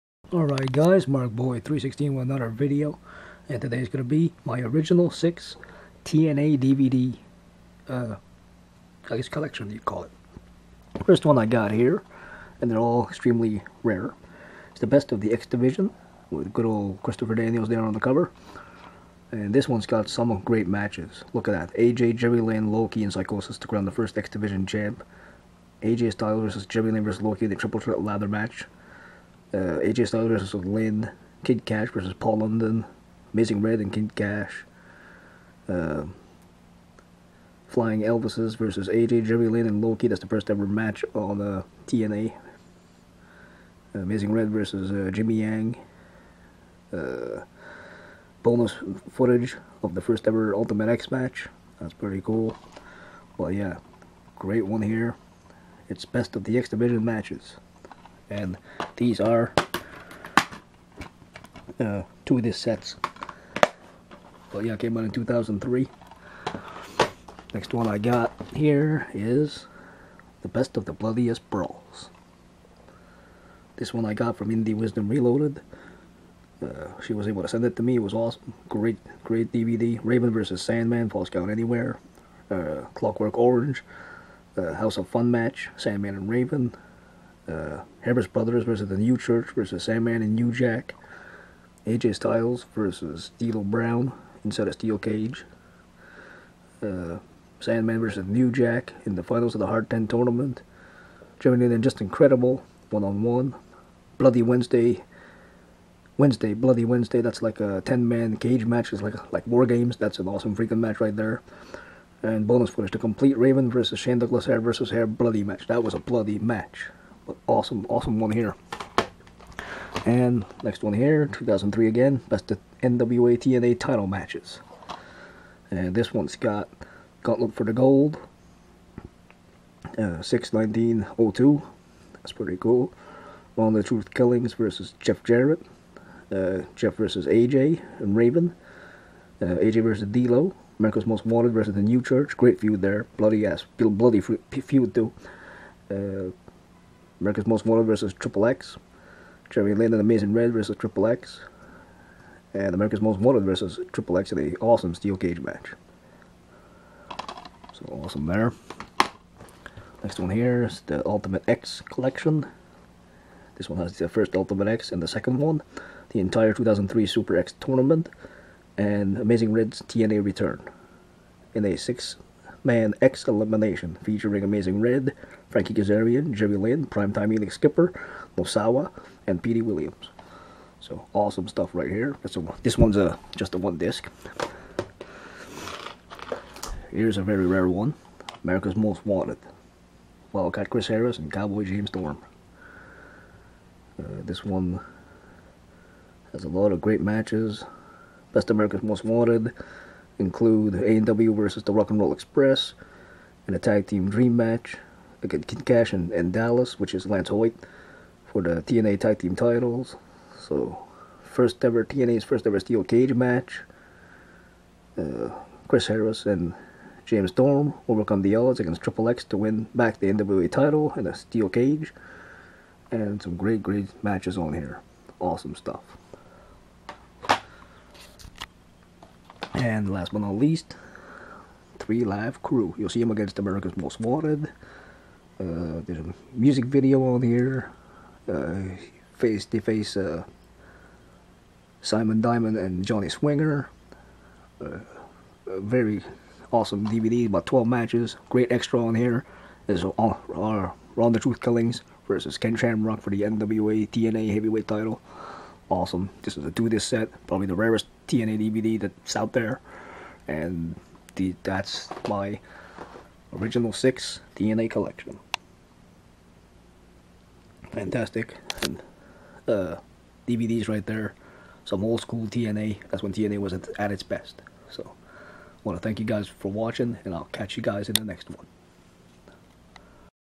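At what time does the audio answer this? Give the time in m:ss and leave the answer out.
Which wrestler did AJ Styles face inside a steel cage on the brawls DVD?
1:33.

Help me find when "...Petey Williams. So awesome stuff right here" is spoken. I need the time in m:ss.
2:59.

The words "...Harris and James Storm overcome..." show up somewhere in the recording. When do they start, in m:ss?
3:35.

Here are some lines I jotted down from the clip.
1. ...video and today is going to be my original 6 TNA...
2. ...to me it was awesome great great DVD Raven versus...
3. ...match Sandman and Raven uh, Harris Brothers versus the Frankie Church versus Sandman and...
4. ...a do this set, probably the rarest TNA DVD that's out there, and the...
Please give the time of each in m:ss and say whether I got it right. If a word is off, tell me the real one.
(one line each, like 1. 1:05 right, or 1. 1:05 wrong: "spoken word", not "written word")
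1. 0:02 right
2. 1:17 right
3. 1:25 wrong: "New", not "Frankie"
4. 4:16 right.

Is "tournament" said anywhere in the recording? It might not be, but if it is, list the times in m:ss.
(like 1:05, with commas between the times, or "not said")
1:40, 2:47.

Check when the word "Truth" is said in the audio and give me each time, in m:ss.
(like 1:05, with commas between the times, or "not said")
2:13, 4:11.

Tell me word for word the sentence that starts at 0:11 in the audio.
First one I got here and they're all extremely rare.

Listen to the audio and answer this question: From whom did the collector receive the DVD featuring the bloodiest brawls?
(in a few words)
Indie Wisdom Reloaded.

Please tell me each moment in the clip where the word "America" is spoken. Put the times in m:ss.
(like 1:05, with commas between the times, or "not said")
2:20, 2:27, 2:32, 3:08, 3:18, 3:53.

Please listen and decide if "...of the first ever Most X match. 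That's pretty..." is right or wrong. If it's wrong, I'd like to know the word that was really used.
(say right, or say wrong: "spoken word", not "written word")
wrong: "Ultimate", not "Most".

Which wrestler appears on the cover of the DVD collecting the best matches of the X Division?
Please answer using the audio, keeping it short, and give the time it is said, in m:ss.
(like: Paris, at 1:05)
Christopher Daniels, at 0:17.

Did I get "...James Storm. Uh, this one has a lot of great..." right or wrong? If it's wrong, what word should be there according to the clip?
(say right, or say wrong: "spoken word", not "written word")
right.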